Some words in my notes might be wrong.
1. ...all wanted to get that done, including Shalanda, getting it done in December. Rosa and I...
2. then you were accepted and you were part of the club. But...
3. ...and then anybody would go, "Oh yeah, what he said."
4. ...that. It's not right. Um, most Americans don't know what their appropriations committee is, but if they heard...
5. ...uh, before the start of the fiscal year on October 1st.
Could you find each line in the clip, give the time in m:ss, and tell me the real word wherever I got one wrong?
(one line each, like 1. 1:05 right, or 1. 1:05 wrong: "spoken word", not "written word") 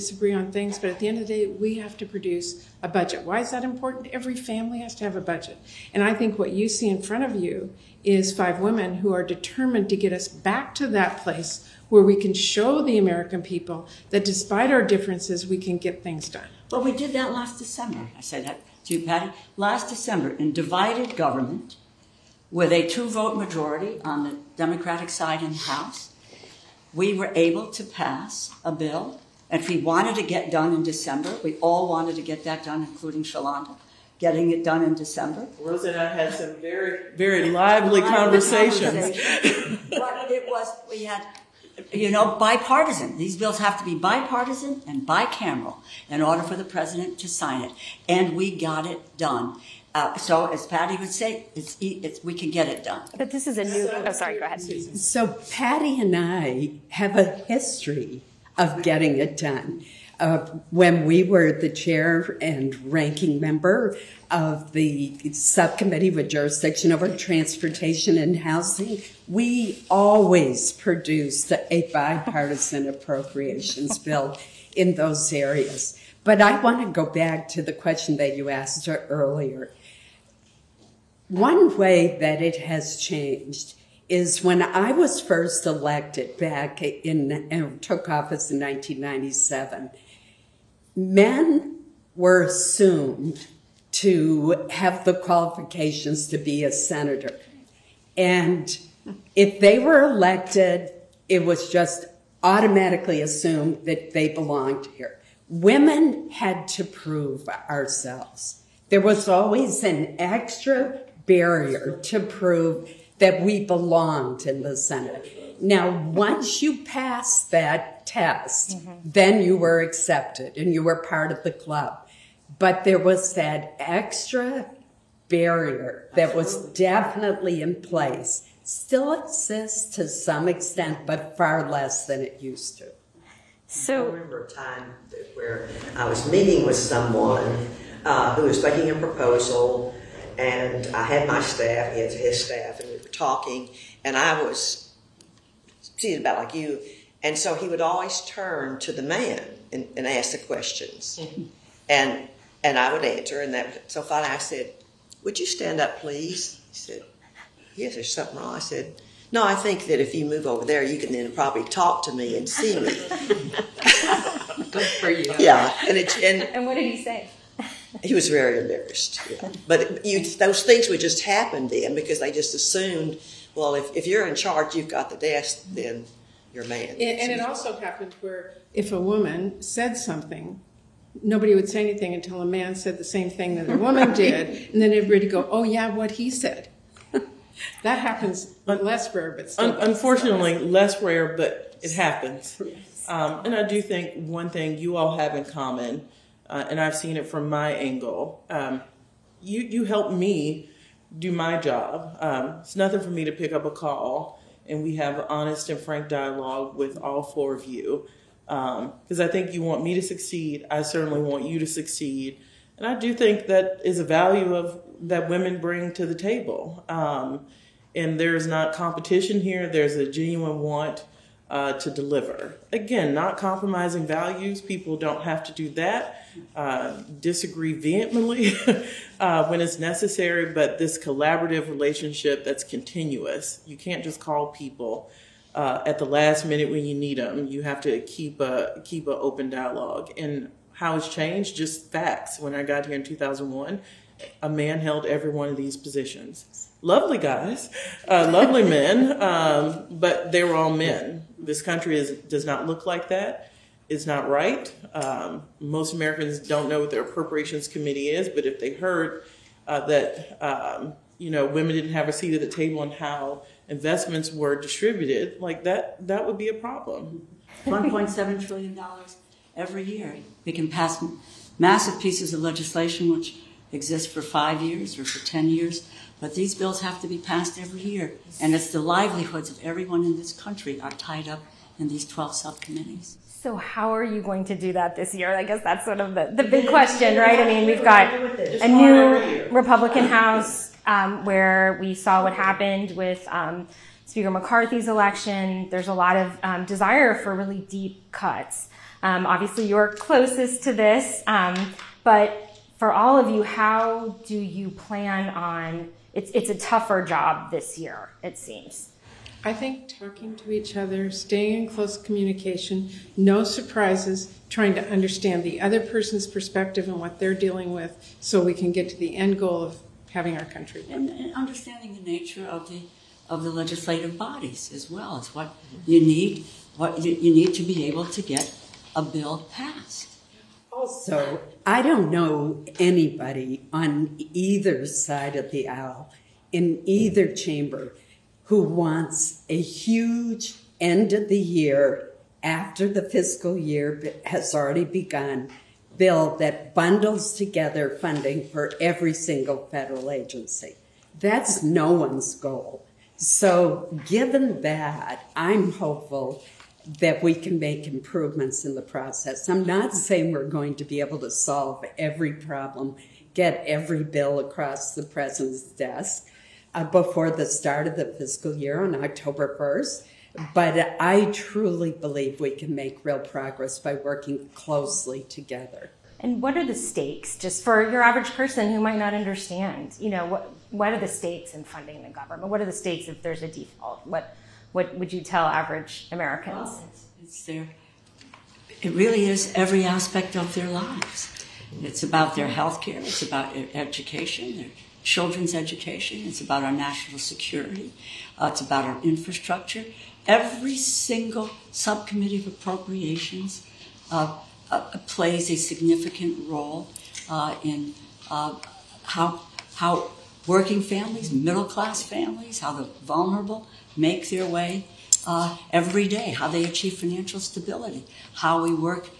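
1. 0:31 right
2. 1:59 right
3. 3:04 wrong: "everybody", not "anybody"
4. 4:13 right
5. 6:06 right.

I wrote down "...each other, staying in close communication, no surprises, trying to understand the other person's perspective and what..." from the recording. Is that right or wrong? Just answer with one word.
right.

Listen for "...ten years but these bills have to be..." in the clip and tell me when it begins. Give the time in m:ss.
4:35.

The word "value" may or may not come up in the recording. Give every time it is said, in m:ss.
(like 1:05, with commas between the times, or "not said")
3:34, 3:44.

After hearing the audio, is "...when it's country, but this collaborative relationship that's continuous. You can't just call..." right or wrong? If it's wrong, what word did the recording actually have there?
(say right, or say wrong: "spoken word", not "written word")
wrong: "necessary", not "country".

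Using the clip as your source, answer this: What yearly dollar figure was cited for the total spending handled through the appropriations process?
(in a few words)
$1.7 trillion.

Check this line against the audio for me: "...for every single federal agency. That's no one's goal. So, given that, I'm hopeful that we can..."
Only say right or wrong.
right.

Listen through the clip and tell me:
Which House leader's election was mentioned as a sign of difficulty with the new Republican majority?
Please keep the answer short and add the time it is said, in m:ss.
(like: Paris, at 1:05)
McCarthy, at 4:54.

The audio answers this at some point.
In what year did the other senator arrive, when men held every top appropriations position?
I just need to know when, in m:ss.
4:03.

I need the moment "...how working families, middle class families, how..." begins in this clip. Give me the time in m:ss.
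6:49.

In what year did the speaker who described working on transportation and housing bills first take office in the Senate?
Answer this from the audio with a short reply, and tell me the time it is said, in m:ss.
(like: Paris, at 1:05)
1997, at 1:28.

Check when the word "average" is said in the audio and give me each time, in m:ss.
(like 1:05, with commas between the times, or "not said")
6:18, 6:25.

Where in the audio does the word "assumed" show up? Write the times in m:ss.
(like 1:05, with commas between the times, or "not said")
1:32, 1:43, 2:52.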